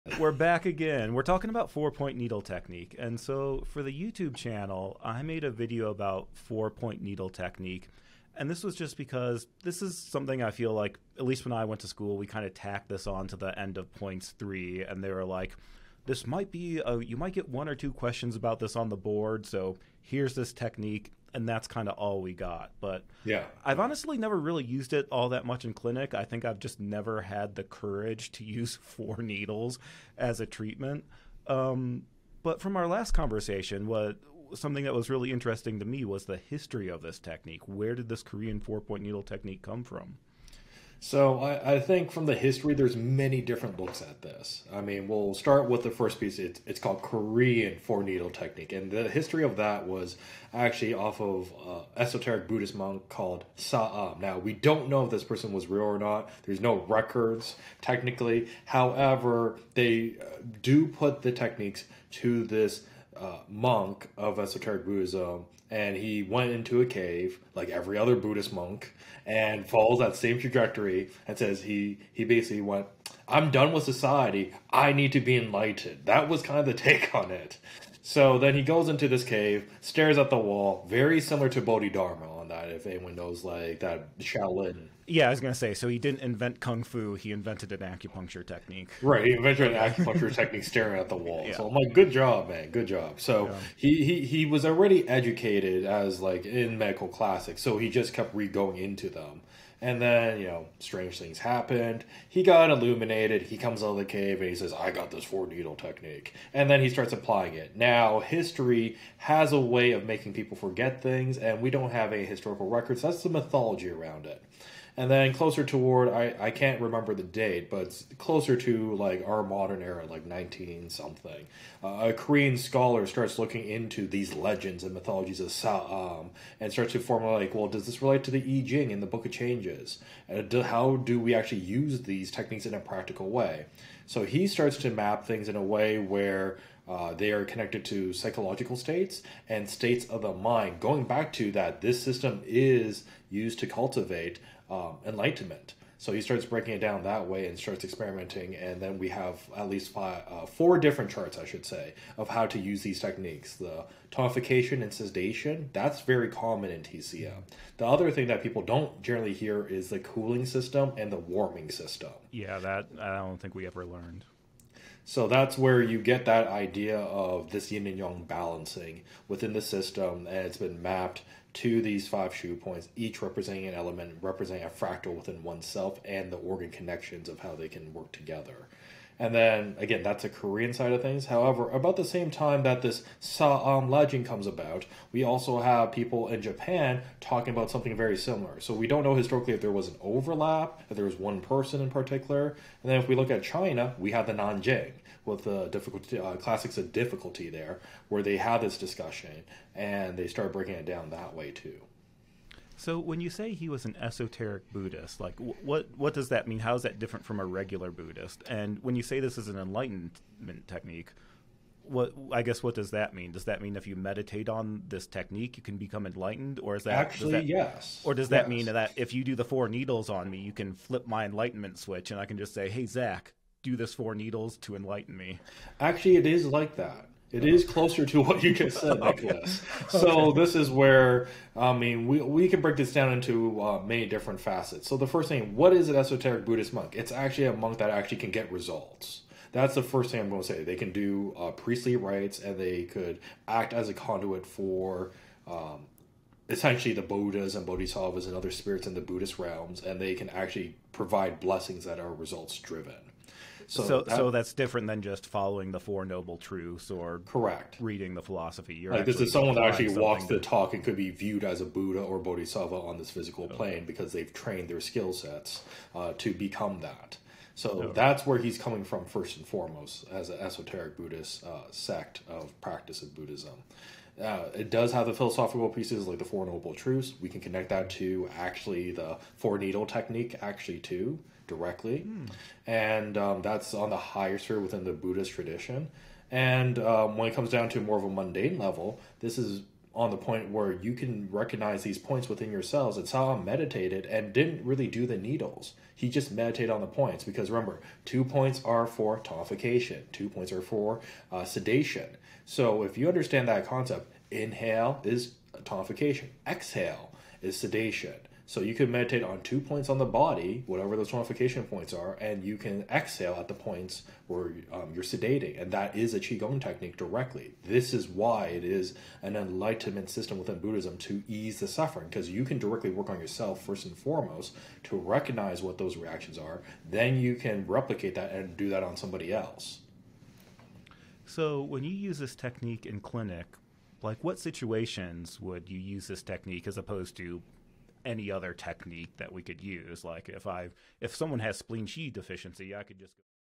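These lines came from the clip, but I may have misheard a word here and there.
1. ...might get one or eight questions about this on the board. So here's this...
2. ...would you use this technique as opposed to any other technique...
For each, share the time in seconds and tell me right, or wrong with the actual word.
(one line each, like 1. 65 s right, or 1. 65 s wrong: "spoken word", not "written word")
1. 17 s wrong: "two", not "eight"
2. 335 s right.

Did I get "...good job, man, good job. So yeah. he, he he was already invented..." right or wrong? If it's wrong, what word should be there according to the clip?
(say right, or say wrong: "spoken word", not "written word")
wrong: "educated", not "invented".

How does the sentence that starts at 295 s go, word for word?
He just meditated on the points because remember, two points are for tonification, two points are for uh, sedation.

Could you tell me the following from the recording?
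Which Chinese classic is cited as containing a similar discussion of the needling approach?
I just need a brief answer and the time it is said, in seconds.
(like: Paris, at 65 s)
Nanjing, at 194 s.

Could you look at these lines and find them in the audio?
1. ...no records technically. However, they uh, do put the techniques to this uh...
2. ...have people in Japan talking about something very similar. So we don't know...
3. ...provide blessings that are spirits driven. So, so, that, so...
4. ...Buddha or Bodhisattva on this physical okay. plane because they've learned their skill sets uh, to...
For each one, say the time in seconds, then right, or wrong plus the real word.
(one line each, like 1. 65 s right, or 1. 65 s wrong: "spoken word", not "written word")
1. 56 s right
2. 185 s right
3. 250 s wrong: "results", not "spirits"
4. 261 s wrong: "trained", not "learned".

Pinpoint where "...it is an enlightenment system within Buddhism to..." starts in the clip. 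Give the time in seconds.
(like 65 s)
318 s.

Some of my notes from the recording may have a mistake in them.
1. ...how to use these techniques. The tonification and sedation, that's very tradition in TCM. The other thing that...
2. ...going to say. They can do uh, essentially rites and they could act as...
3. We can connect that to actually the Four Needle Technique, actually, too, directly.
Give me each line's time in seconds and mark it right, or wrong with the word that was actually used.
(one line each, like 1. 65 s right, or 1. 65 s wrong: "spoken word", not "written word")
1. 152 s wrong: "common", not "tradition"
2. 240 s wrong: "priestly", not "essentially"
3. 277 s right.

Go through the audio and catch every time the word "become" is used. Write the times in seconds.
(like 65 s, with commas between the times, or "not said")
215 s, 266 s.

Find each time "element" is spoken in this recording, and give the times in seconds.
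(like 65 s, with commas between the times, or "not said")
173 s.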